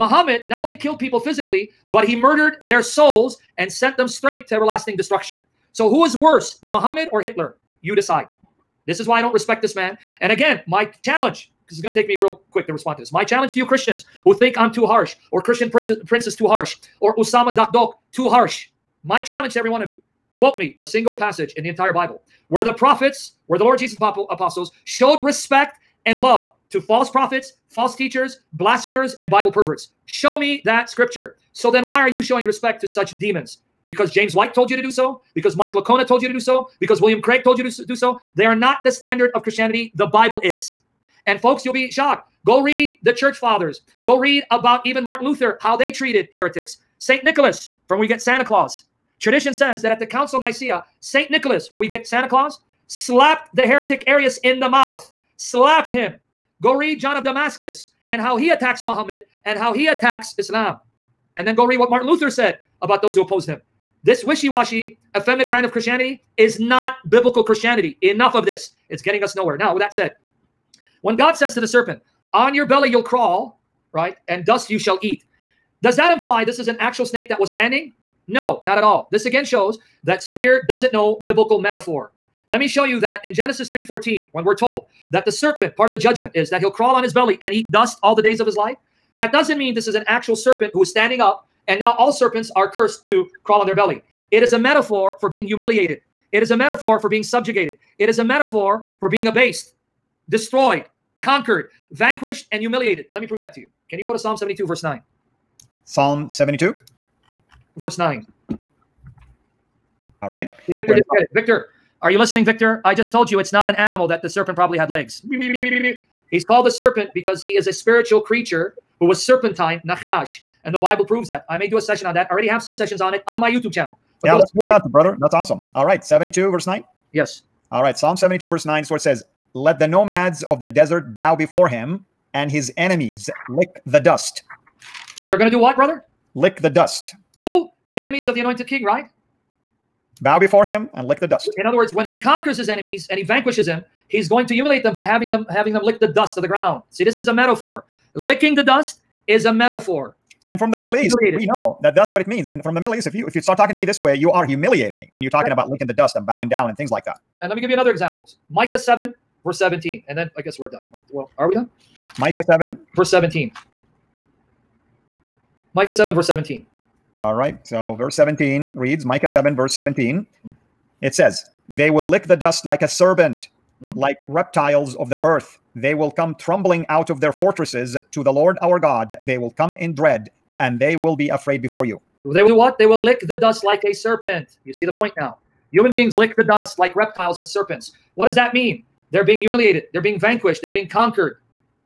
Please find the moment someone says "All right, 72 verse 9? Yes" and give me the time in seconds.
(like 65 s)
125 s.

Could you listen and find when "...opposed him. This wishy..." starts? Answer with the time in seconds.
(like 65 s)
63 s.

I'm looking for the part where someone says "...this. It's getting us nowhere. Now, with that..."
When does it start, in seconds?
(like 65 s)
68 s.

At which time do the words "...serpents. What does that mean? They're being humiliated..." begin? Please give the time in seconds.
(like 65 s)
187 s.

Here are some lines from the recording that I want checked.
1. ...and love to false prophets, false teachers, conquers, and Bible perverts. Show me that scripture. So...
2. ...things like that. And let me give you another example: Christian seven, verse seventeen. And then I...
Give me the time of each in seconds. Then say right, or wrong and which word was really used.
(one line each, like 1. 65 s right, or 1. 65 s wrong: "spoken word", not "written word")
1. 26 s wrong: "blasphemers", not "conquers"
2. 156 s wrong: "Micah", not "Christian".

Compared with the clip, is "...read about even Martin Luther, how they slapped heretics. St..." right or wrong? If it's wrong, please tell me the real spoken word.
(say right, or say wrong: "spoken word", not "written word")
wrong: "treated", not "slapped".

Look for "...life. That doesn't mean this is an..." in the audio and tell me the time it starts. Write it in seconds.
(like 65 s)
88 s.